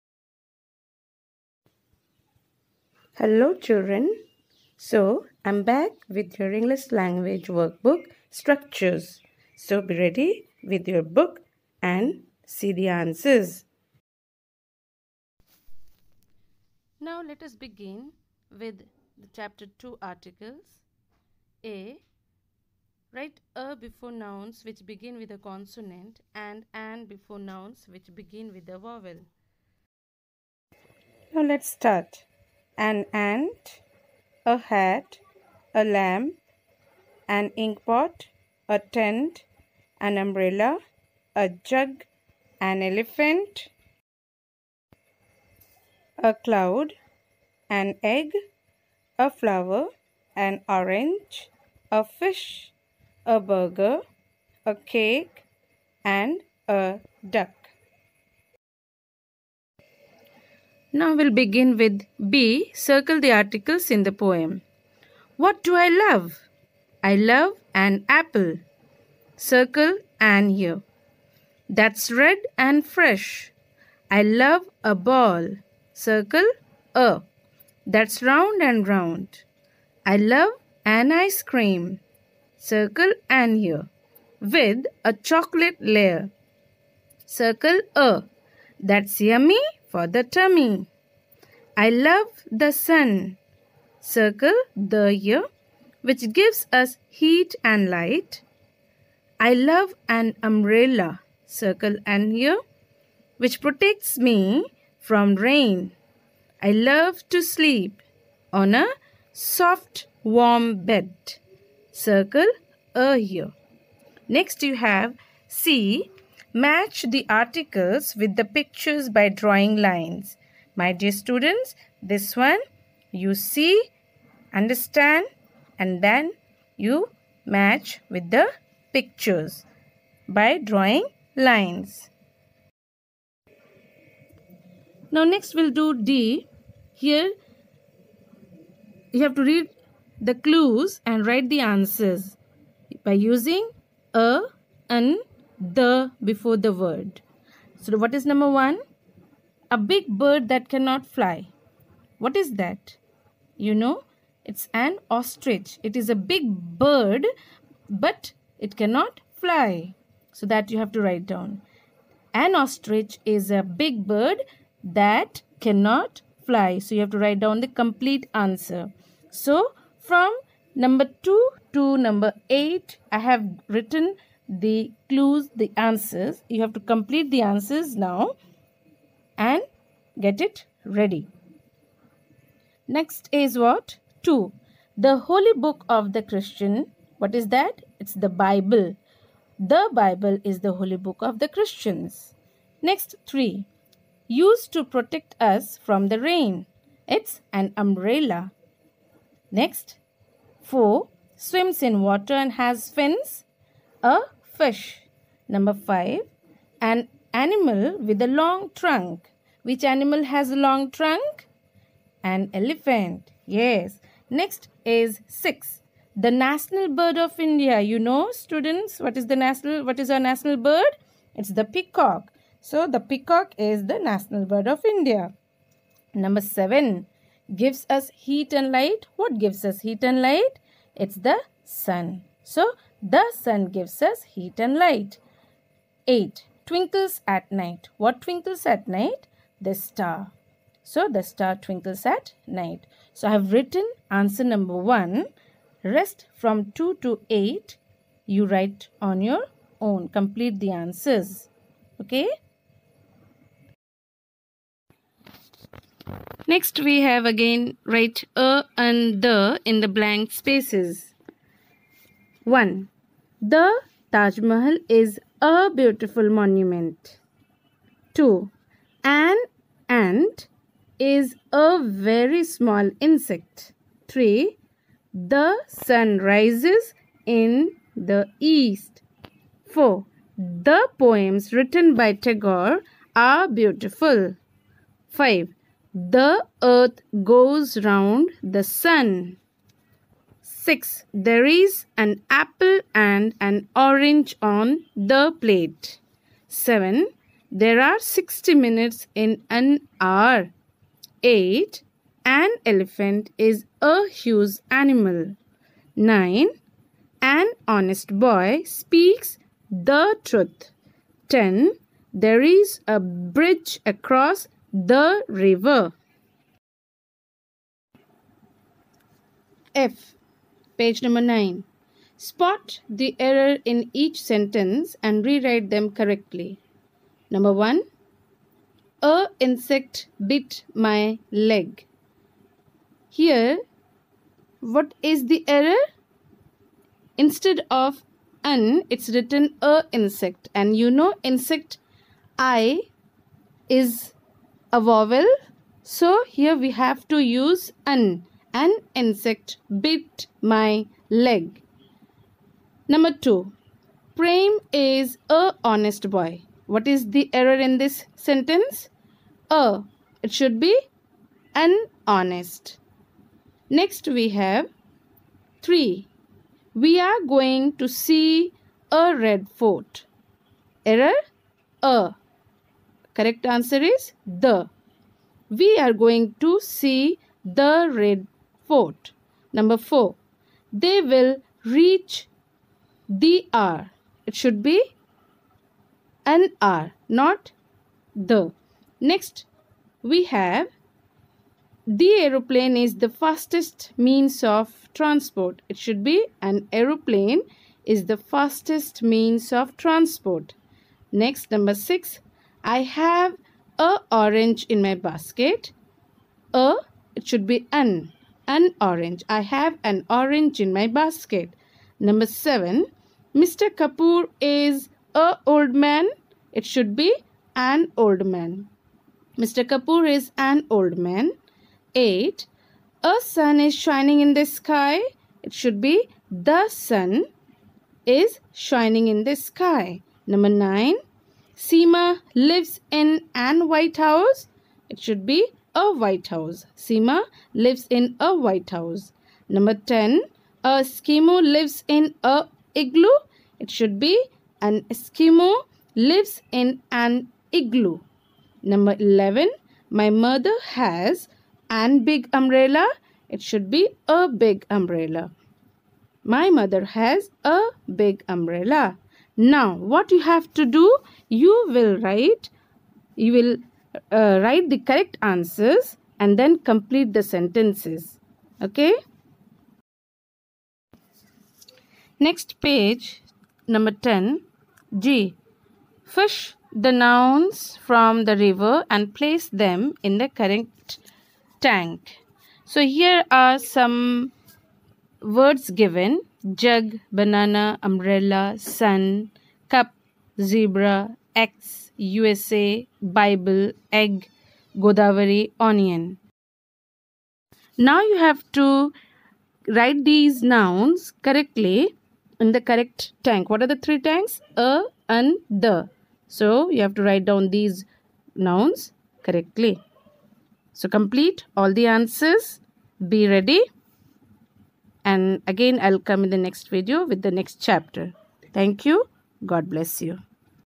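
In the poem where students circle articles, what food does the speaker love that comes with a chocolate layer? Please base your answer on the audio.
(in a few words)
ice cream.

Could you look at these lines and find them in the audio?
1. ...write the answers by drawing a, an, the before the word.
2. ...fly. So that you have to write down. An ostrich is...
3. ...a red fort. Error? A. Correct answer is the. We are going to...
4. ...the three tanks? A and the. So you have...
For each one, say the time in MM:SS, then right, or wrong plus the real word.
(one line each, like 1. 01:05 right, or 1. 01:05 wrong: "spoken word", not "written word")
1. 02:21 wrong: "using", not "drawing"
2. 02:39 right
3. 06:08 right
4. 08:23 right.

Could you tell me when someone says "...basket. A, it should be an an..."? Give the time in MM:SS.
06:44.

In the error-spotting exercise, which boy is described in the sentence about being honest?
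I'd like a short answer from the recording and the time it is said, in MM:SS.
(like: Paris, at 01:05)
Prem, at 05:54.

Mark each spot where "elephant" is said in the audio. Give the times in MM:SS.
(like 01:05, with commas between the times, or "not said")
00:42, 03:32, 05:02.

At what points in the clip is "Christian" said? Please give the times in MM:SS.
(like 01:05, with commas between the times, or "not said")
03:06, 03:11.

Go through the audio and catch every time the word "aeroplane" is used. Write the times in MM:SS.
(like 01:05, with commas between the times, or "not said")
06:32, 06:36.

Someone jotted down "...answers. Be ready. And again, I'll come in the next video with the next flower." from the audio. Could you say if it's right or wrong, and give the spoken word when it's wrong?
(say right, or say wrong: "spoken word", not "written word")
wrong: "chapter", not "flower".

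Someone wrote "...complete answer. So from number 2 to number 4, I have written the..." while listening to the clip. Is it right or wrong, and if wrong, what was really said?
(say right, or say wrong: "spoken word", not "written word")
wrong: "8", not "4".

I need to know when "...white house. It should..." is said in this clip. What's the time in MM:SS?
07:13.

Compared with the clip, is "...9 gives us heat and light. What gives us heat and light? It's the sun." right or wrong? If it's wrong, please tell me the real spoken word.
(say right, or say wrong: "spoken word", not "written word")
wrong: "7", not "9".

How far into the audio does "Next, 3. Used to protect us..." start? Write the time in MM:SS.
03:12.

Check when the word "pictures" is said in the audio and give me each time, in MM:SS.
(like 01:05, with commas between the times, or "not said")
01:58, 02:08.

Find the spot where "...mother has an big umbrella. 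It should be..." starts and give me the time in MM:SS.
07:30.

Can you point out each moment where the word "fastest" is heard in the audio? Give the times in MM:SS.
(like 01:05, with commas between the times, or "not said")
06:33, 06:38.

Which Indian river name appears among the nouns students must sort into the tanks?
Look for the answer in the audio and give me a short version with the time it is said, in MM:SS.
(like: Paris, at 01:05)
Godavari, at 08:14.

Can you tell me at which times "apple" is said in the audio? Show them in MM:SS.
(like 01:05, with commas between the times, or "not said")
01:08, 04:52.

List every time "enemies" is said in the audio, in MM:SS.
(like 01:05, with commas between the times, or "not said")
not said.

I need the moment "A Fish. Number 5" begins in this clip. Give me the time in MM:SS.
03:24.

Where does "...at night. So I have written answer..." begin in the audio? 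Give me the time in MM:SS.
04:02.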